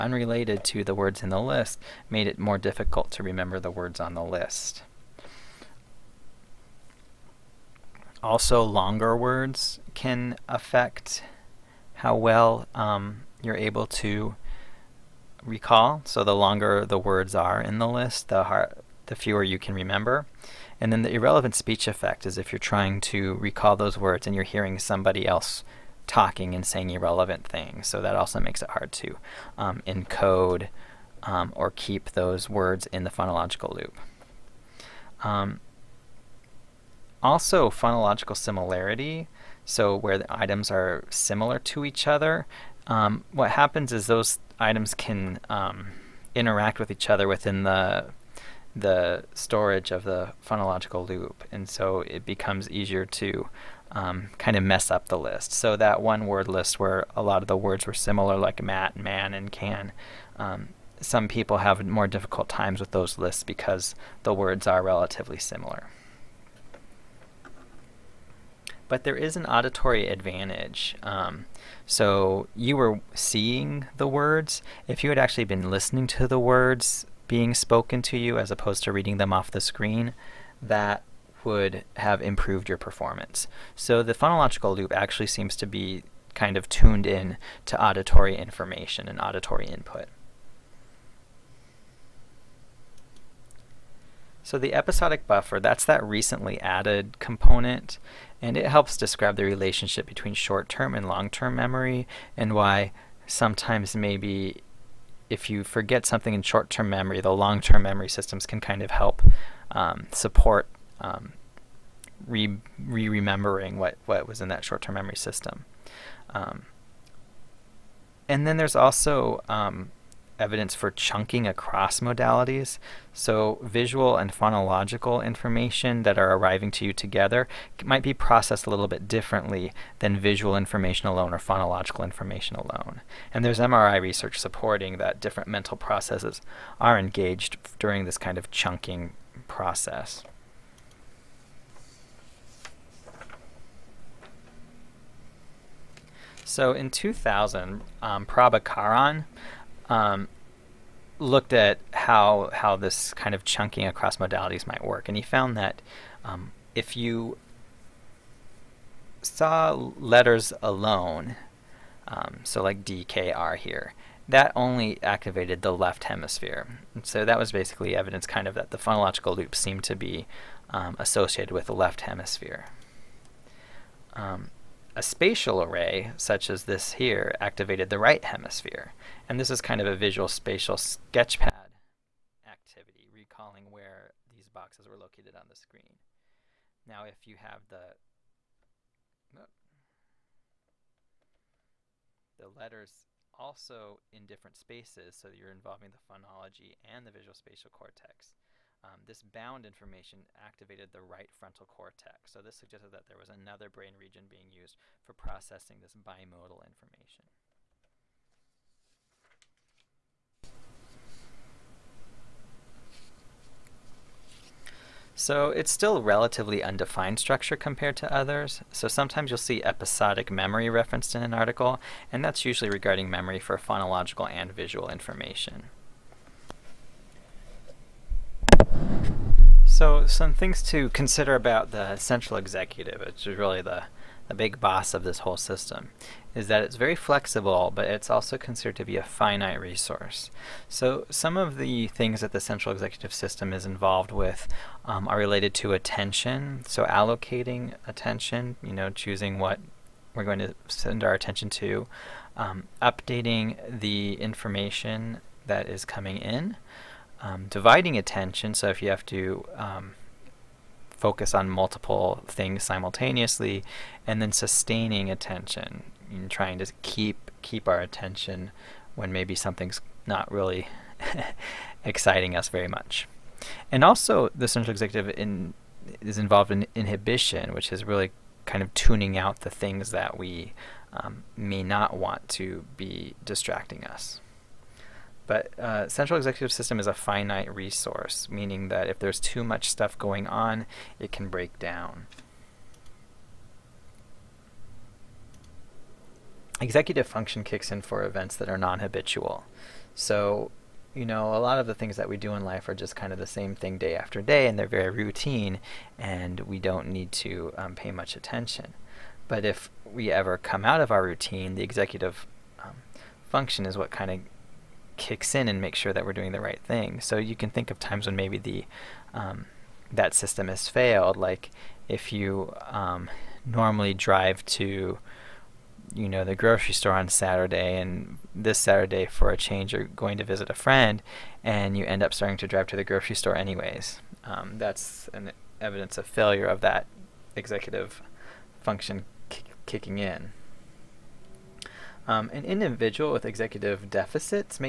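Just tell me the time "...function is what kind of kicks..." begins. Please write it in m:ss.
5:13.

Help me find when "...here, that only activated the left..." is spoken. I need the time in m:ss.
2:43.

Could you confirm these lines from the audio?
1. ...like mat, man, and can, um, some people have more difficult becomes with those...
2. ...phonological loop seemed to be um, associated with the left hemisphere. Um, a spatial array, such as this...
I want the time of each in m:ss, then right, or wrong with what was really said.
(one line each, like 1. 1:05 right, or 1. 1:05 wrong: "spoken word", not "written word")
1. 0:58 wrong: "times", not "becomes"
2. 2:48 right.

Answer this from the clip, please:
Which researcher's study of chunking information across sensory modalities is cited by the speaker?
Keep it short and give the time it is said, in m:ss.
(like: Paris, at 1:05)
Prabhakaran, at 2:28.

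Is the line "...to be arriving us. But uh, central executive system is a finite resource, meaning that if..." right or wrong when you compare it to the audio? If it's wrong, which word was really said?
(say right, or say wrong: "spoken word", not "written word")
wrong: "distracting", not "arriving".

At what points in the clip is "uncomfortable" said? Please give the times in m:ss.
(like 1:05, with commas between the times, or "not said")
not said.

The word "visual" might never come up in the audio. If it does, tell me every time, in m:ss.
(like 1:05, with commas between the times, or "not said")
2:03, 2:10, 2:59, 3:17, 3:44.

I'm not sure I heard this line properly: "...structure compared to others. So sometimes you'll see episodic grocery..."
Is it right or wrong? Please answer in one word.
wrong.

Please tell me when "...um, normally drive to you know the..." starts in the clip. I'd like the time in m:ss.
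5:22.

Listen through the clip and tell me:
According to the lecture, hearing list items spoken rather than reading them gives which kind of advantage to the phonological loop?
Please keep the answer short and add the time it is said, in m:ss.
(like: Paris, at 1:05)
auditory advantage, at 1:09.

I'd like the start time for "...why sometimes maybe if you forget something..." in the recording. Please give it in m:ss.
1:42.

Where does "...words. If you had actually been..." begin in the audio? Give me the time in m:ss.
1:14.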